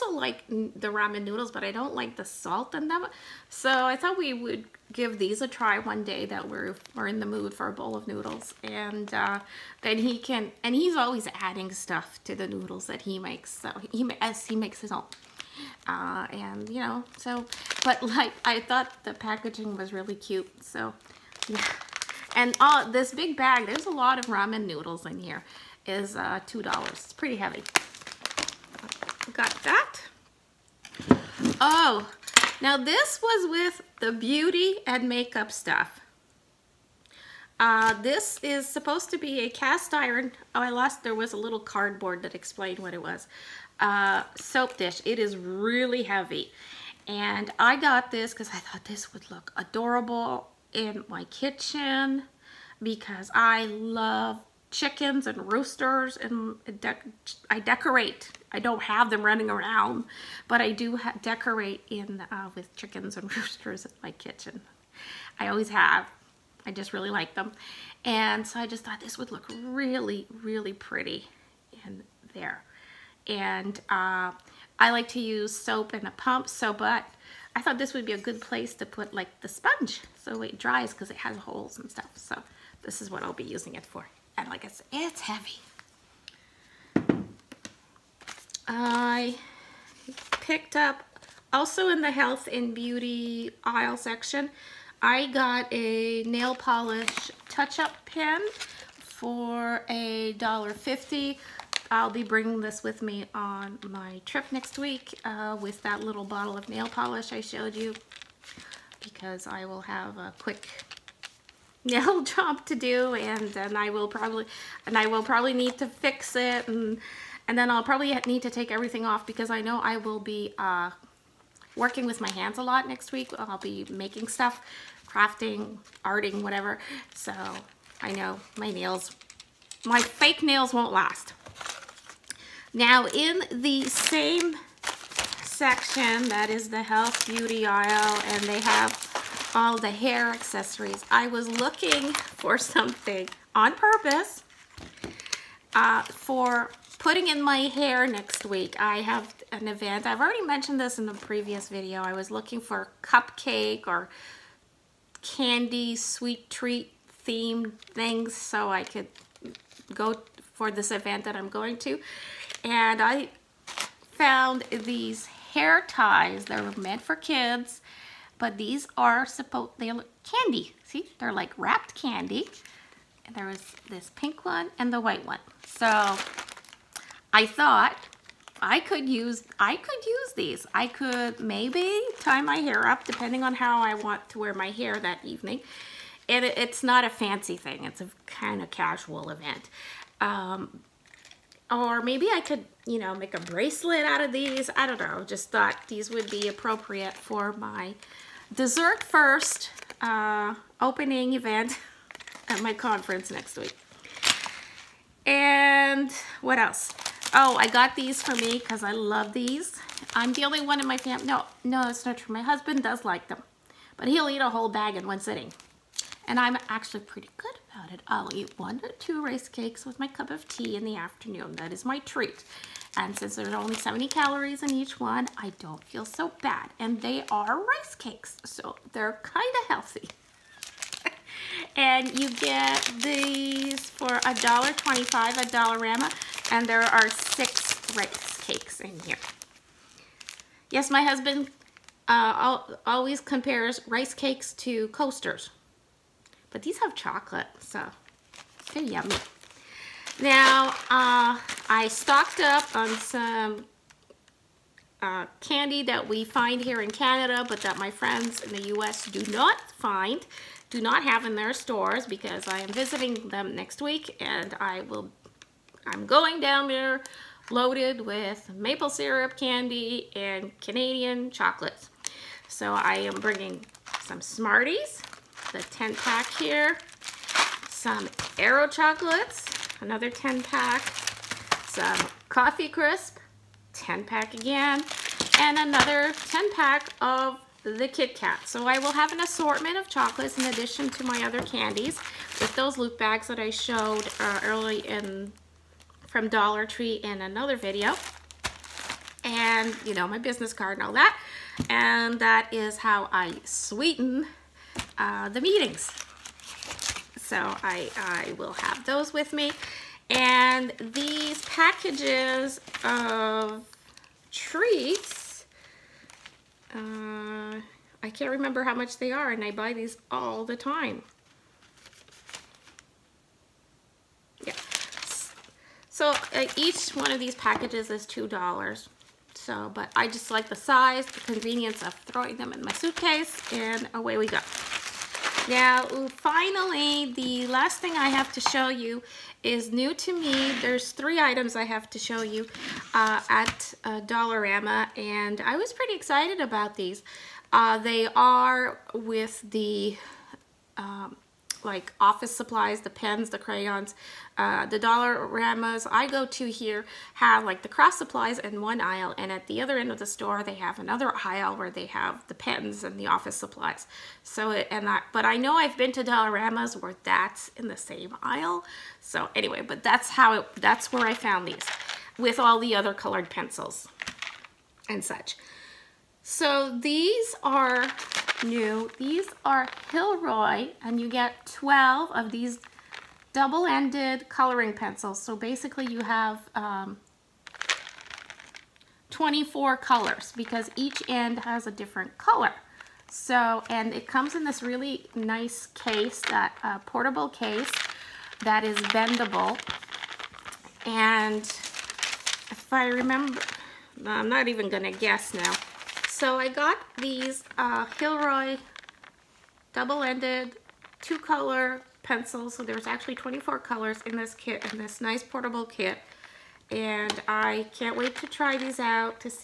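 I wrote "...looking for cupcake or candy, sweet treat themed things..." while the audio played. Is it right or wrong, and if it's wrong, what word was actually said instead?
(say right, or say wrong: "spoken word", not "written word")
right.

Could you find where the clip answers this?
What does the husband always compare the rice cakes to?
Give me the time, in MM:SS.
04:04.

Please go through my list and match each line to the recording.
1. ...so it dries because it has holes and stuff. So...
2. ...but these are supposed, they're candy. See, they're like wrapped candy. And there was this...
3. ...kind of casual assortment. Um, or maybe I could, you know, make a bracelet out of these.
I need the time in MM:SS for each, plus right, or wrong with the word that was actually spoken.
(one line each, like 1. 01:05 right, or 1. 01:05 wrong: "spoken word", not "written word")
1. 01:20 right
2. 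02:48 right
3. 03:08 wrong: "event", not "assortment".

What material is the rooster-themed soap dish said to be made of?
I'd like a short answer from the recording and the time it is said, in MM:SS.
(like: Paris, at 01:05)
cast iron, at 00:39.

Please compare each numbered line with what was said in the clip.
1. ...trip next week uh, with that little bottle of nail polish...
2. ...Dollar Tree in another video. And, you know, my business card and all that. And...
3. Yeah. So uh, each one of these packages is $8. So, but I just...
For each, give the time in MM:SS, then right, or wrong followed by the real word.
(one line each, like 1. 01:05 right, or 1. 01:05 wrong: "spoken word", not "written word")
1. 01:44 right
2. 04:56 right
3. 05:24 wrong: "2", not "8".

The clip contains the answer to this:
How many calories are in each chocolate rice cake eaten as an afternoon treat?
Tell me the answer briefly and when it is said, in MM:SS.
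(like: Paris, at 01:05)
70, at 03:43.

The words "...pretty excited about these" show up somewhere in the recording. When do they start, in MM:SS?
05:45.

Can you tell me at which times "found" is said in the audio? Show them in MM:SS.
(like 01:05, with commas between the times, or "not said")
02:44, 06:11.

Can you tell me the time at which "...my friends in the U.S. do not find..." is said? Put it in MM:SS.
04:17.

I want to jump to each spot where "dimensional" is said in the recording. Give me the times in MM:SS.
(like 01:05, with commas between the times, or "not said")
not said.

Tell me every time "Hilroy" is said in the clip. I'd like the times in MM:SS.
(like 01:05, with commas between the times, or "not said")
06:19, 06:47.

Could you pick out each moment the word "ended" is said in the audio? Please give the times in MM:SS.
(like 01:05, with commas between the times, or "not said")
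06:23, 06:49.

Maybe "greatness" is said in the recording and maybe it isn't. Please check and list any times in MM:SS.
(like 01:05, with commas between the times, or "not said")
not said.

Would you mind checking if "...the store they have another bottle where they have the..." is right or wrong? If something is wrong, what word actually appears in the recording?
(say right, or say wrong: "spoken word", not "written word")
wrong: "aisle", not "bottle".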